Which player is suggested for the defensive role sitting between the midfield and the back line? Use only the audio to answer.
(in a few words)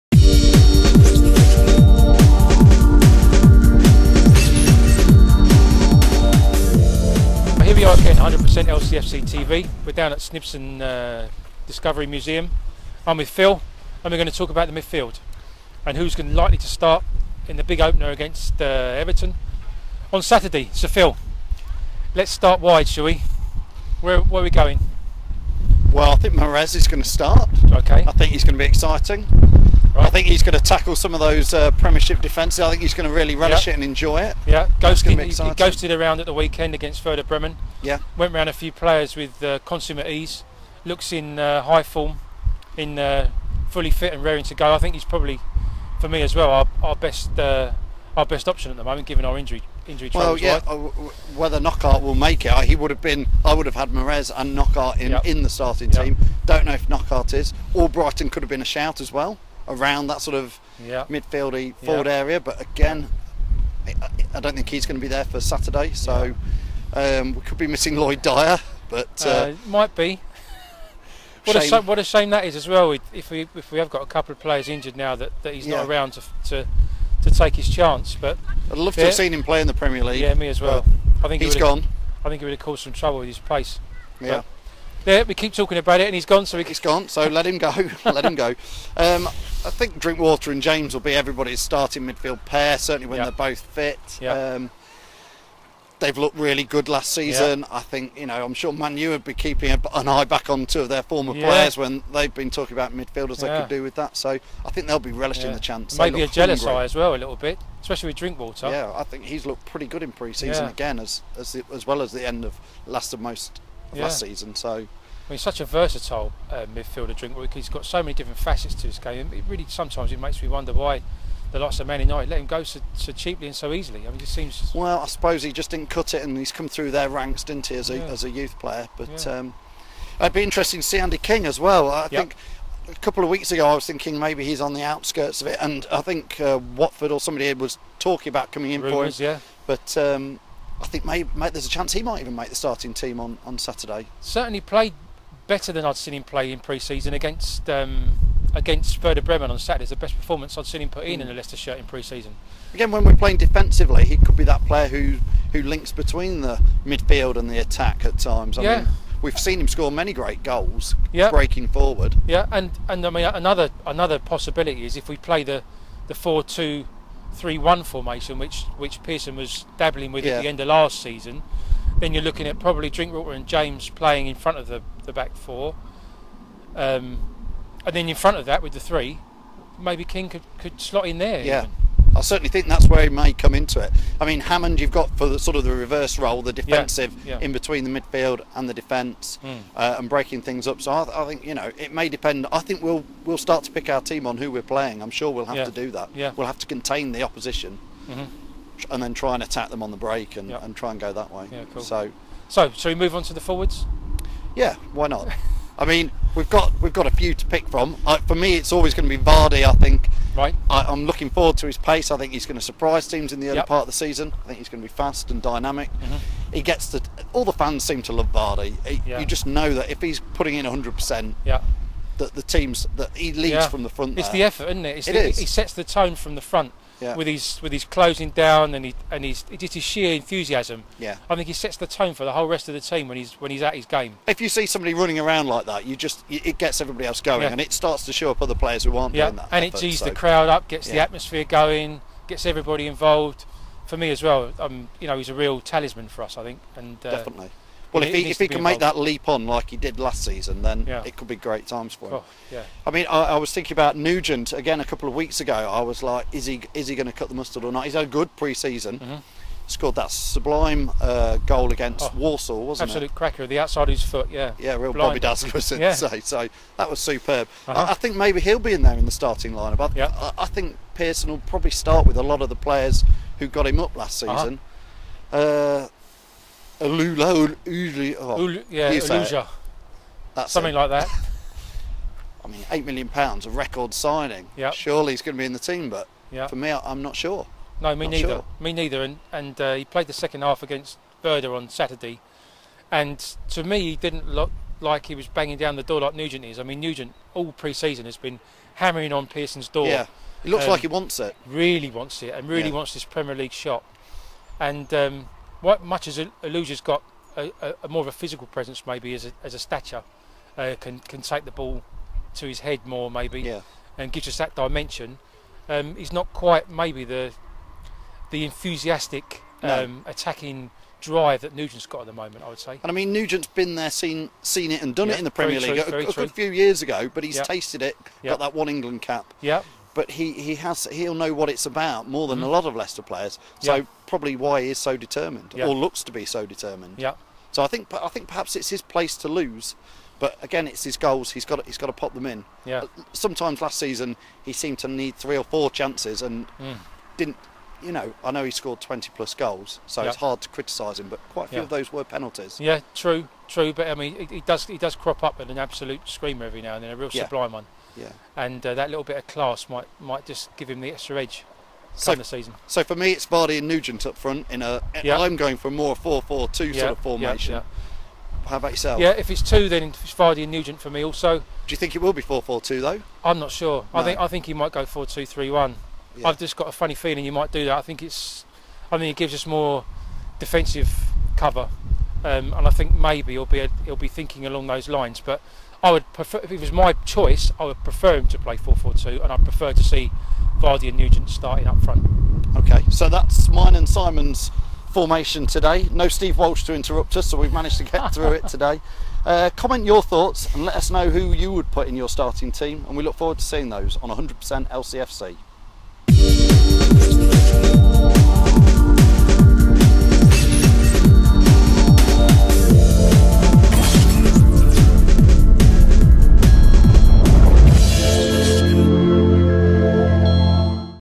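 Hammond.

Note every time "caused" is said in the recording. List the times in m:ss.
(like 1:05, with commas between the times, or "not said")
1:22.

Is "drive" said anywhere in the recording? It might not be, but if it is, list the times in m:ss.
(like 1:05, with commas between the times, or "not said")
5:21.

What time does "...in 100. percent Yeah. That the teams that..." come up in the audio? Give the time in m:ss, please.
3:40.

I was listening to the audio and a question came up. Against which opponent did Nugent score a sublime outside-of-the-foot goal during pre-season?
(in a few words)
Warsaw.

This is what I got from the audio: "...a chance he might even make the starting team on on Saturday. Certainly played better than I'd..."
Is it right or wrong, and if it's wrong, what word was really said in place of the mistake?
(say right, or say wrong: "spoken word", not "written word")
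right.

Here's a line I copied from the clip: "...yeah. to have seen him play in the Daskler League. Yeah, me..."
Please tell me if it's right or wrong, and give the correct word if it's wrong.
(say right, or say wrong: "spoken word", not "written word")
wrong: "Premier", not "Daskler".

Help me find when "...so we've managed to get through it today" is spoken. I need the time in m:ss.
6:37.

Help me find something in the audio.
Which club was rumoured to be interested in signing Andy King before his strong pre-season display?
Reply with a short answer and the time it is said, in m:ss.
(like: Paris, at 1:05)
Watford, at 2:16.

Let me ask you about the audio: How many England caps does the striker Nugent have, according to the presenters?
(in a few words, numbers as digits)
1.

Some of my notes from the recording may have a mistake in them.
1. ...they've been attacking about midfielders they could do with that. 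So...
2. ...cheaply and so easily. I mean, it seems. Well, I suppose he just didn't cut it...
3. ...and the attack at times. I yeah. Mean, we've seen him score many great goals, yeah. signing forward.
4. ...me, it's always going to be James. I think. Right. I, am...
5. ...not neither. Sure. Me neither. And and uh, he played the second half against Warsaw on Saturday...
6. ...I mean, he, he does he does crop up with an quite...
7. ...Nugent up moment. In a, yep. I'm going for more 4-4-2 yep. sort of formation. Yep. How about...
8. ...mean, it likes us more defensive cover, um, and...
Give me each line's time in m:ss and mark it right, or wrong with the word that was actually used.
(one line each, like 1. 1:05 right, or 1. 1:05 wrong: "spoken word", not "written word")
1. 1:42 wrong: "talking", not "attacking"
2. 2:03 right
3. 2:37 wrong: "breaking", not "signing"
4. 3:28 wrong: "Vardy", not "James"
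5. 4:48 wrong: "Werder", not "Warsaw"
6. 5:53 wrong: "absolute", not "quite"
7. 6:03 wrong: "front", not "moment"
8. 6:18 wrong: "gives", not "likes".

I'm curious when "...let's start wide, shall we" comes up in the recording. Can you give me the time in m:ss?
0:22.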